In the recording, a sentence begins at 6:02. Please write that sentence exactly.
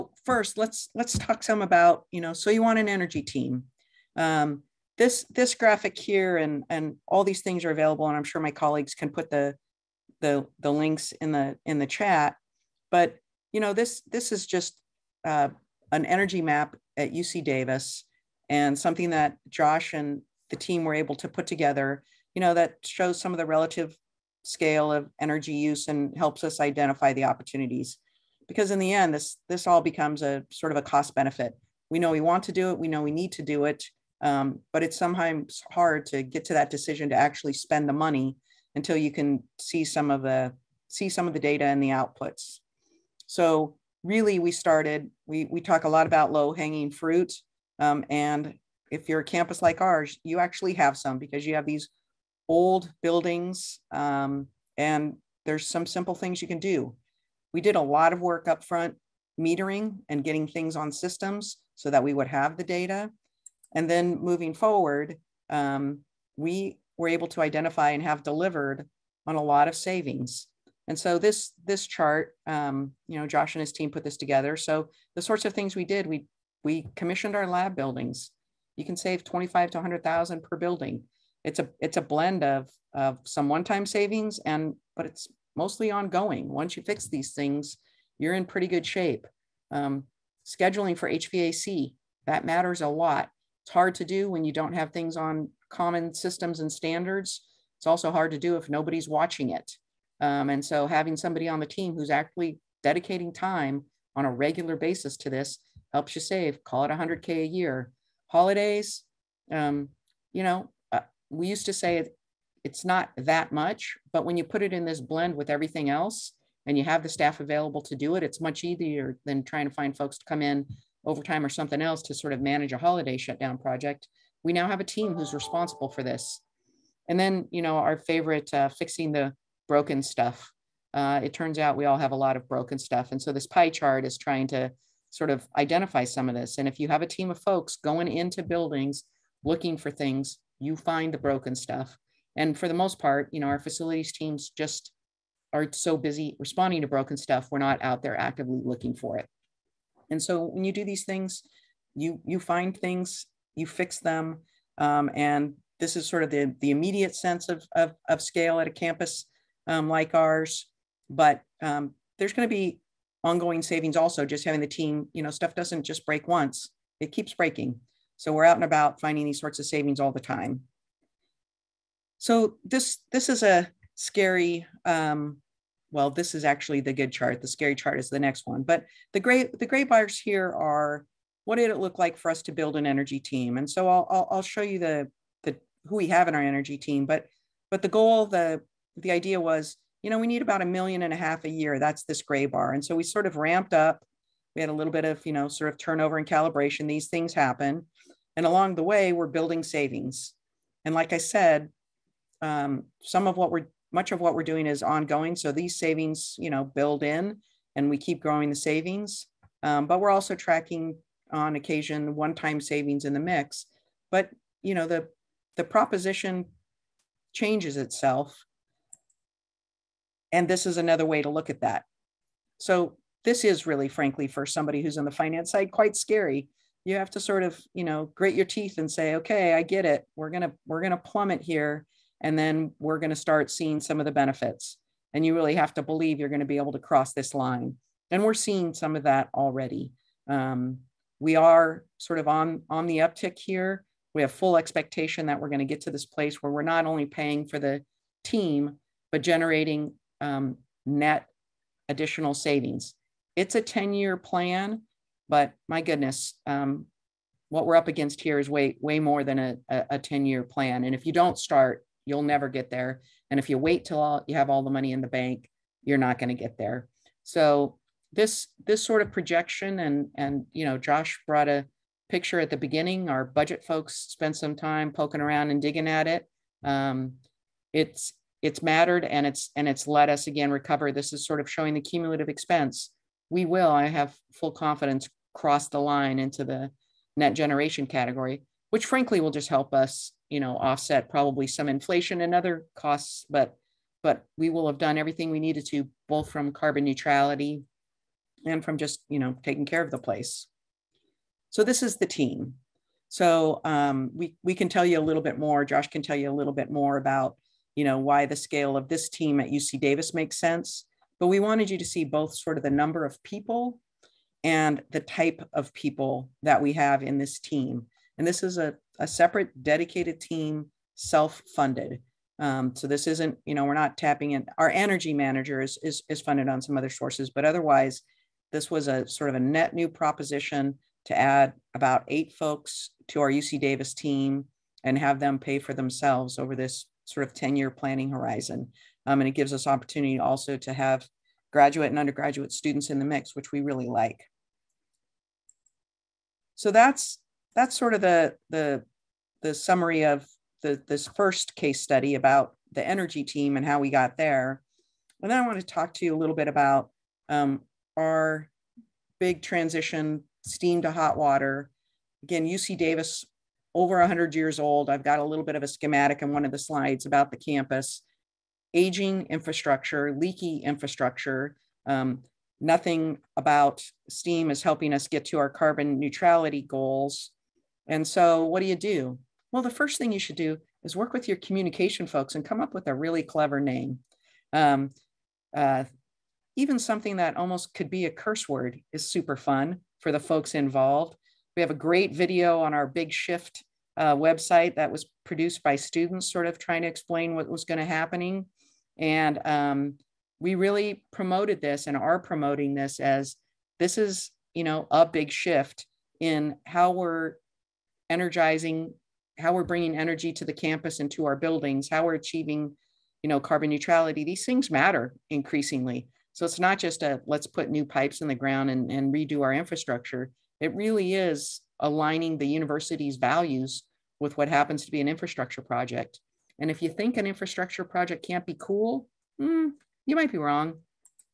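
Again, UC Davis over 100 years old.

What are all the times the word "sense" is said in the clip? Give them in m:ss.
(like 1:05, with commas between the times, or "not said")
2:37, 5:10.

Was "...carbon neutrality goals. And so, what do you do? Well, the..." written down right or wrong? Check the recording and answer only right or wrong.
right.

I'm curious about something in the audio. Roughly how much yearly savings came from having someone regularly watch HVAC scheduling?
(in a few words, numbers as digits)
100K.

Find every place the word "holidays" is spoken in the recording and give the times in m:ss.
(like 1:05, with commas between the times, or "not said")
1:48, 2:02.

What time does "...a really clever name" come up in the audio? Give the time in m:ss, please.
6:22.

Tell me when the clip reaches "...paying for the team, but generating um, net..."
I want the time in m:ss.
4:07.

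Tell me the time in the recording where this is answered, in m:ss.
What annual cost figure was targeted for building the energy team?
3:10.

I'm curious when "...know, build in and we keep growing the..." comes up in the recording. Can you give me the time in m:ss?
3:26.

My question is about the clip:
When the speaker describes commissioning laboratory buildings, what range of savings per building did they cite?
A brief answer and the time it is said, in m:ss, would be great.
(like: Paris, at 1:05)
25 to 100,000, at 1:19.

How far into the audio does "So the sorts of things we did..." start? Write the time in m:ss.
1:14.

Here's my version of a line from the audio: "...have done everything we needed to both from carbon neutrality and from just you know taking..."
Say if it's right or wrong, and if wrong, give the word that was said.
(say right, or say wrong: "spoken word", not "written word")
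right.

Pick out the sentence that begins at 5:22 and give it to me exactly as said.
Um, so this isn't, you know, we're not tapping in.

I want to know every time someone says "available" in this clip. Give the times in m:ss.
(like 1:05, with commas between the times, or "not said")
0:07, 1:57.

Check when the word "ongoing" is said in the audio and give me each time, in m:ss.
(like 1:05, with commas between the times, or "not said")
1:25, 2:43, 3:24.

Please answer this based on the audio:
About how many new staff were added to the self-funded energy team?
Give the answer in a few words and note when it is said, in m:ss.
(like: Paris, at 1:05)
about eight, at 5:31.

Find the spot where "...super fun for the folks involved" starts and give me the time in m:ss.
6:29.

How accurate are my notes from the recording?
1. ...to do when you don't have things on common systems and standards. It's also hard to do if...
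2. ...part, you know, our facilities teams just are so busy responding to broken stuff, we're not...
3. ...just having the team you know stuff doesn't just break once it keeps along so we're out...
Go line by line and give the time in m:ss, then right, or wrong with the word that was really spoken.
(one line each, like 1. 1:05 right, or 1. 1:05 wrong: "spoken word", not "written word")
1. 1:33 right
2. 2:22 right
3. 2:44 wrong: "breaking", not "along".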